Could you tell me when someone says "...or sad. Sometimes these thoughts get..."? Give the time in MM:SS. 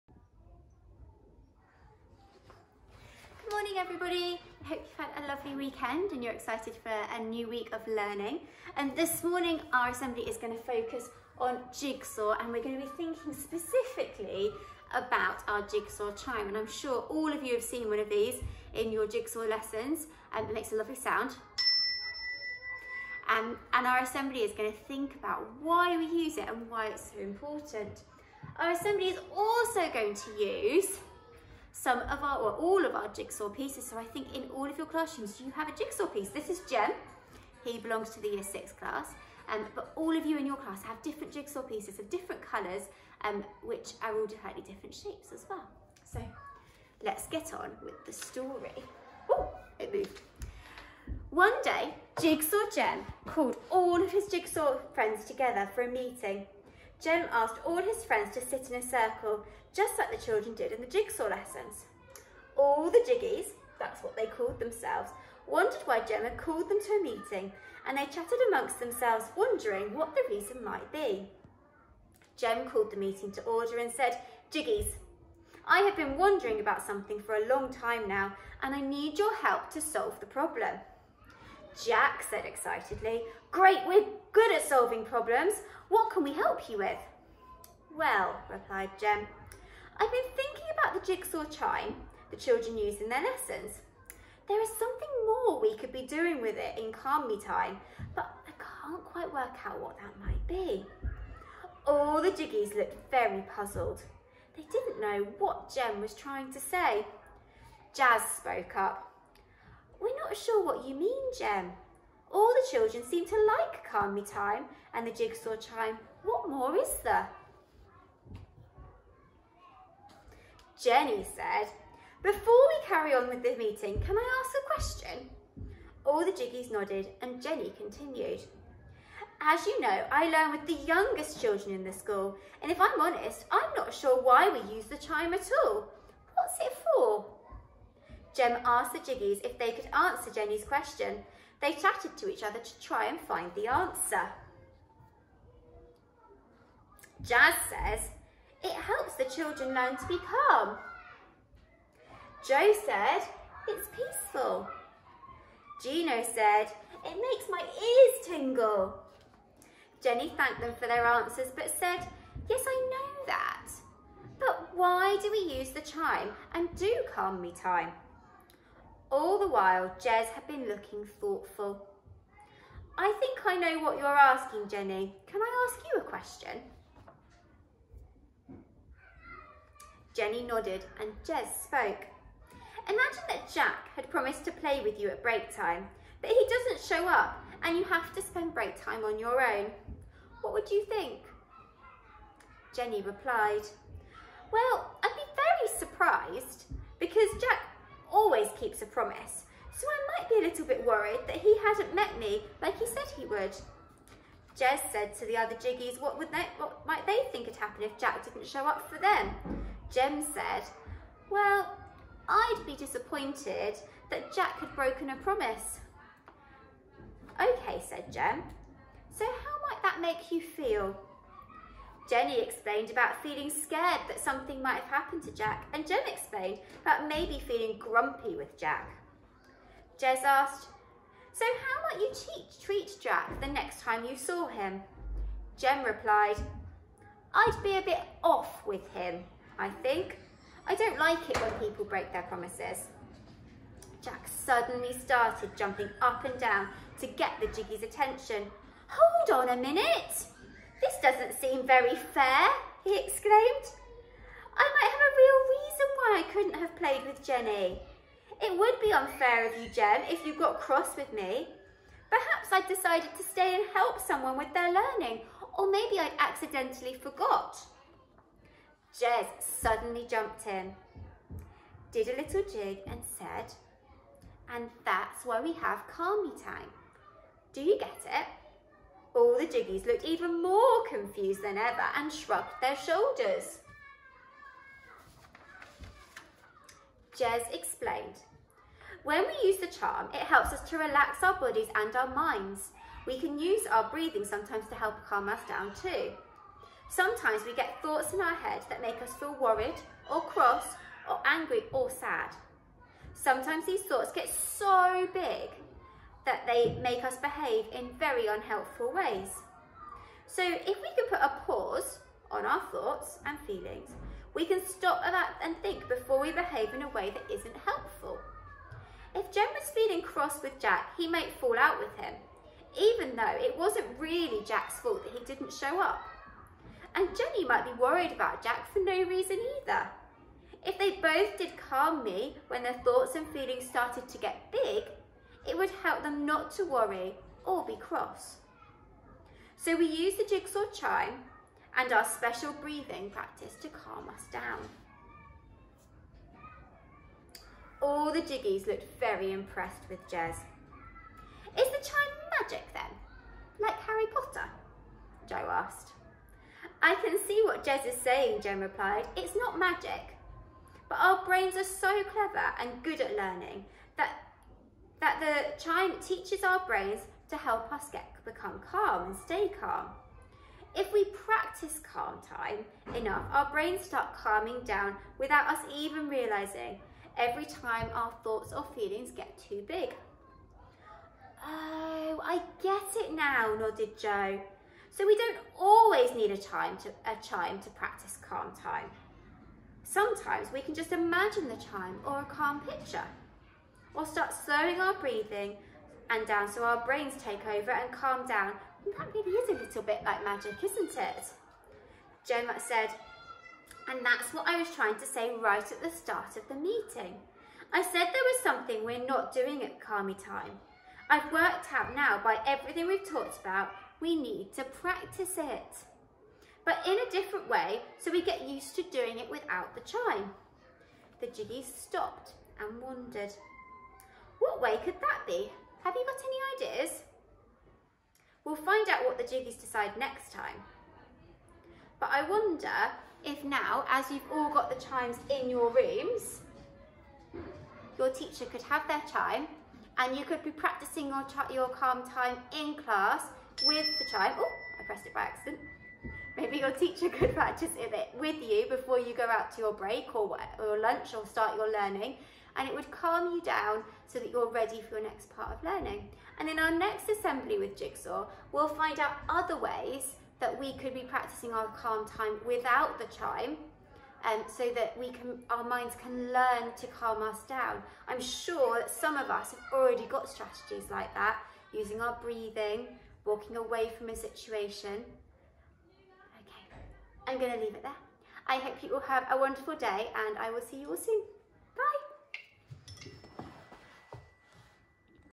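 05:01.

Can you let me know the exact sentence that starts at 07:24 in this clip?
Oh, I pressed it by accident.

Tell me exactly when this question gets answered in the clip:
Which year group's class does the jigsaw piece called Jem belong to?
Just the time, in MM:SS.
00:38.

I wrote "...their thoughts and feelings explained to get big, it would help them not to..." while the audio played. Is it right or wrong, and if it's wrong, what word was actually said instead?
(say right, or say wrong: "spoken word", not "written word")
wrong: "started", not "explained".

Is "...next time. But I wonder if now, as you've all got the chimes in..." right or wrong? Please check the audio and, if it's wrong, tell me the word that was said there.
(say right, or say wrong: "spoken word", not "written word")
right.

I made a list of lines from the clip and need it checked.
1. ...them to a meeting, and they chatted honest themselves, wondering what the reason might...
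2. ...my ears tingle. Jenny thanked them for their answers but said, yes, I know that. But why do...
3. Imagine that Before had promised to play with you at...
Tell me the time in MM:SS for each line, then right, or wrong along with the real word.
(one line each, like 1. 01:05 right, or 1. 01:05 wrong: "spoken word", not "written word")
1. 01:06 wrong: "amongst", not "honest"
2. 02:37 right
3. 03:02 wrong: "Jack", not "Before".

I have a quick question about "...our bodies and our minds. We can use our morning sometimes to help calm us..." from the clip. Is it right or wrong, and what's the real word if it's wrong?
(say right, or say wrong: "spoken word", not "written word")
wrong: "breathing", not "morning".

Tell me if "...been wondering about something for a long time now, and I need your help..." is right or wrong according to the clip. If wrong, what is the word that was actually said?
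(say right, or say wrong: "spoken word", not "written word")
right.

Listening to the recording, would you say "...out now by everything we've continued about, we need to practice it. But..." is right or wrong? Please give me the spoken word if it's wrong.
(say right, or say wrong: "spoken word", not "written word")
wrong: "talked", not "continued".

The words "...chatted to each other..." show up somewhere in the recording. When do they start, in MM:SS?
02:21.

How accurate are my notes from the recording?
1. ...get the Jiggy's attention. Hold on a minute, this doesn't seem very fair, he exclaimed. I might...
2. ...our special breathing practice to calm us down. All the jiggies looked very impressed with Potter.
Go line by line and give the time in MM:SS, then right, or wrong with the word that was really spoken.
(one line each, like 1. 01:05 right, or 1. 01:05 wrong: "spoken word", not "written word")
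1. 04:07 right
2. 05:41 wrong: "Jez", not "Potter".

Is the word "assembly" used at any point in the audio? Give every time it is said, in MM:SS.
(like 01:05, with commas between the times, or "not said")
00:09, 00:23, 00:28, 07:37.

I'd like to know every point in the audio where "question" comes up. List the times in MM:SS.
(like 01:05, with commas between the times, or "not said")
02:04, 02:20, 02:56.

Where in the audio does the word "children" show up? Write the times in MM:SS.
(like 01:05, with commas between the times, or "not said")
01:00, 01:32, 01:52, 02:11, 02:29.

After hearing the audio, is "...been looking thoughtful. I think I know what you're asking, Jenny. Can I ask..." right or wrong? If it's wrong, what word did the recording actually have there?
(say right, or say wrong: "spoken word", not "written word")
right.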